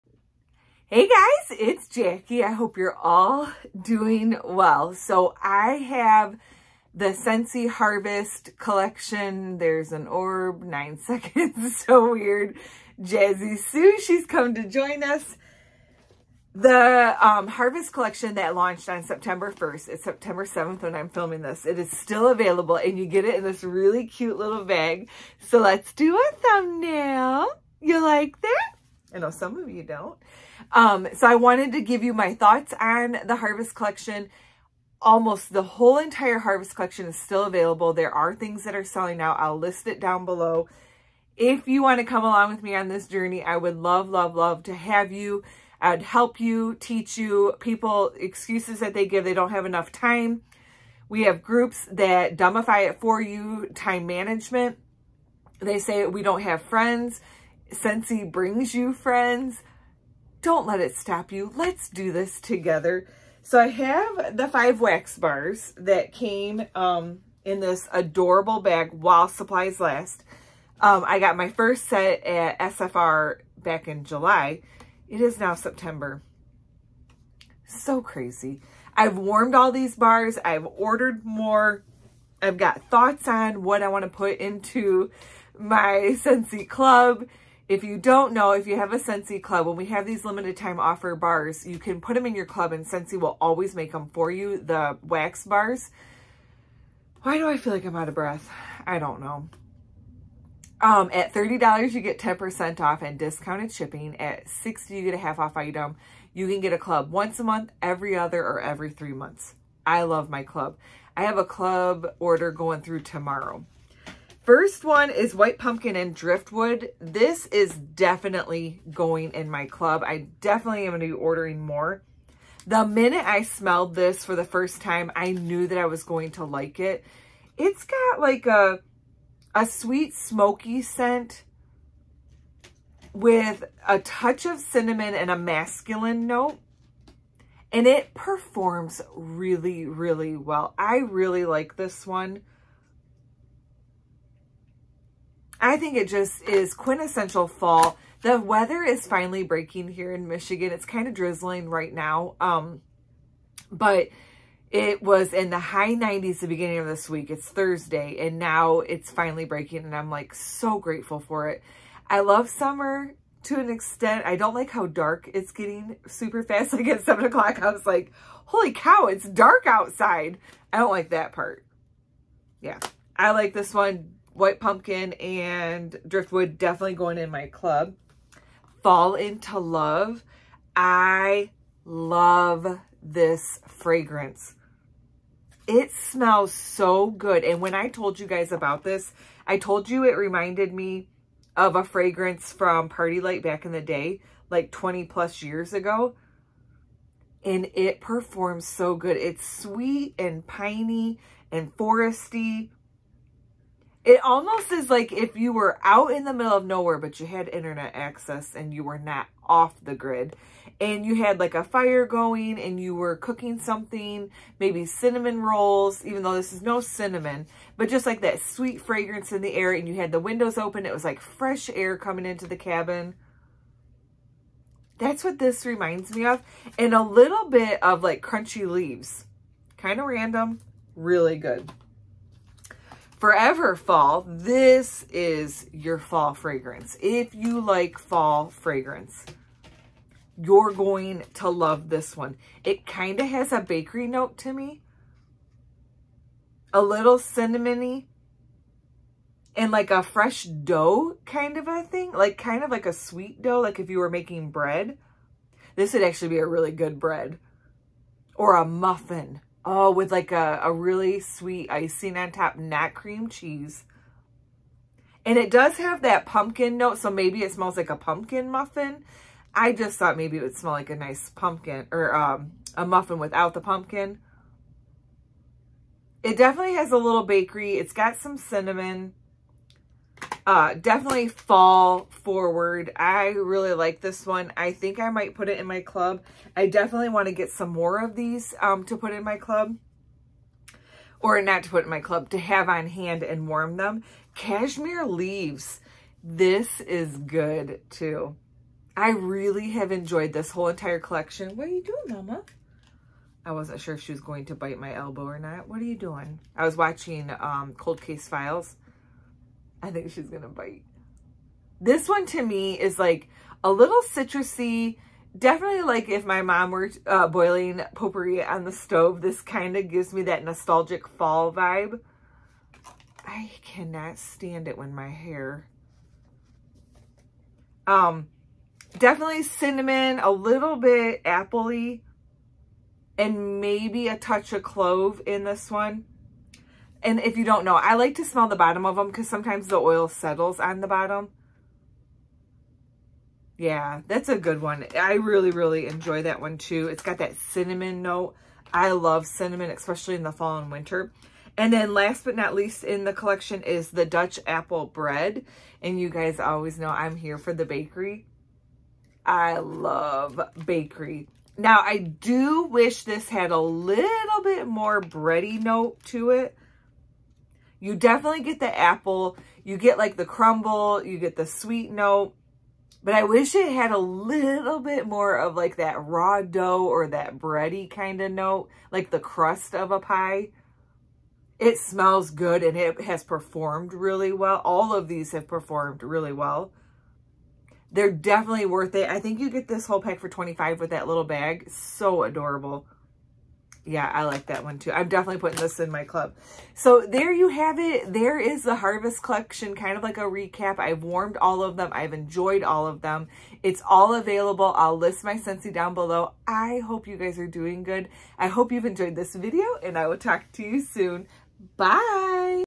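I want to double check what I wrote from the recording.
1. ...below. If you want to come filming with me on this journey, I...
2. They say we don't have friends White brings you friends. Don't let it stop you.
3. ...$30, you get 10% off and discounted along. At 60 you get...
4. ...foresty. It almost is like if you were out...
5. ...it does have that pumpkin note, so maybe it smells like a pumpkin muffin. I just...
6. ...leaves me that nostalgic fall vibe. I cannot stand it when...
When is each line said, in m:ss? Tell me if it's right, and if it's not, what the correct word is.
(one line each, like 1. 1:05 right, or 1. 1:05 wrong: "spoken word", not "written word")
1. 0:40 wrong: "along", not "filming"
2. 0:55 wrong: "Scentsy", not "White"
3. 1:41 wrong: "shipping", not "along"
4. 3:21 right
5. 4:25 right
6. 5:19 wrong: "gives", not "leaves".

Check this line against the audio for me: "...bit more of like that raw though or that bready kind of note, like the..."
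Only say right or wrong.
wrong.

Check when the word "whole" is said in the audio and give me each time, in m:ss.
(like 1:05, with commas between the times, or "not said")
0:35, 5:00, 6:29.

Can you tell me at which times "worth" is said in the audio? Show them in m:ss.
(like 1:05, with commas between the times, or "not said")
6:28.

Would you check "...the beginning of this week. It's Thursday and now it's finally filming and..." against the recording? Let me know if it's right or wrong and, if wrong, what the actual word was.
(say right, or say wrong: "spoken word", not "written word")
wrong: "breaking", not "filming".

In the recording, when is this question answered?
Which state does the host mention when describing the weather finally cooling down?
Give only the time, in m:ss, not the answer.
2:30.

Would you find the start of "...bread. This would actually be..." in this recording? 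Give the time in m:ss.
4:14.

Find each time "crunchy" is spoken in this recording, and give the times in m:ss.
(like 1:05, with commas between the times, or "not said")
3:48.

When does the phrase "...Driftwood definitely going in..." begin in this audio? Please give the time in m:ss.
2:56.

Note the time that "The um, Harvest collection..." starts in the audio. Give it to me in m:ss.
0:16.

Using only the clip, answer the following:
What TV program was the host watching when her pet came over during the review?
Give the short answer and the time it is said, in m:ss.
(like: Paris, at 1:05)
Cold Case Files, at 5:07.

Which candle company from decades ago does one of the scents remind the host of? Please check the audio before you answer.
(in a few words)
PartyLight.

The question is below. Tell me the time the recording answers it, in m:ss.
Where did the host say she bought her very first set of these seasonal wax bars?
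1:12.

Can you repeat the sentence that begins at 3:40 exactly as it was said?
It was like fresh air coming into the cabin.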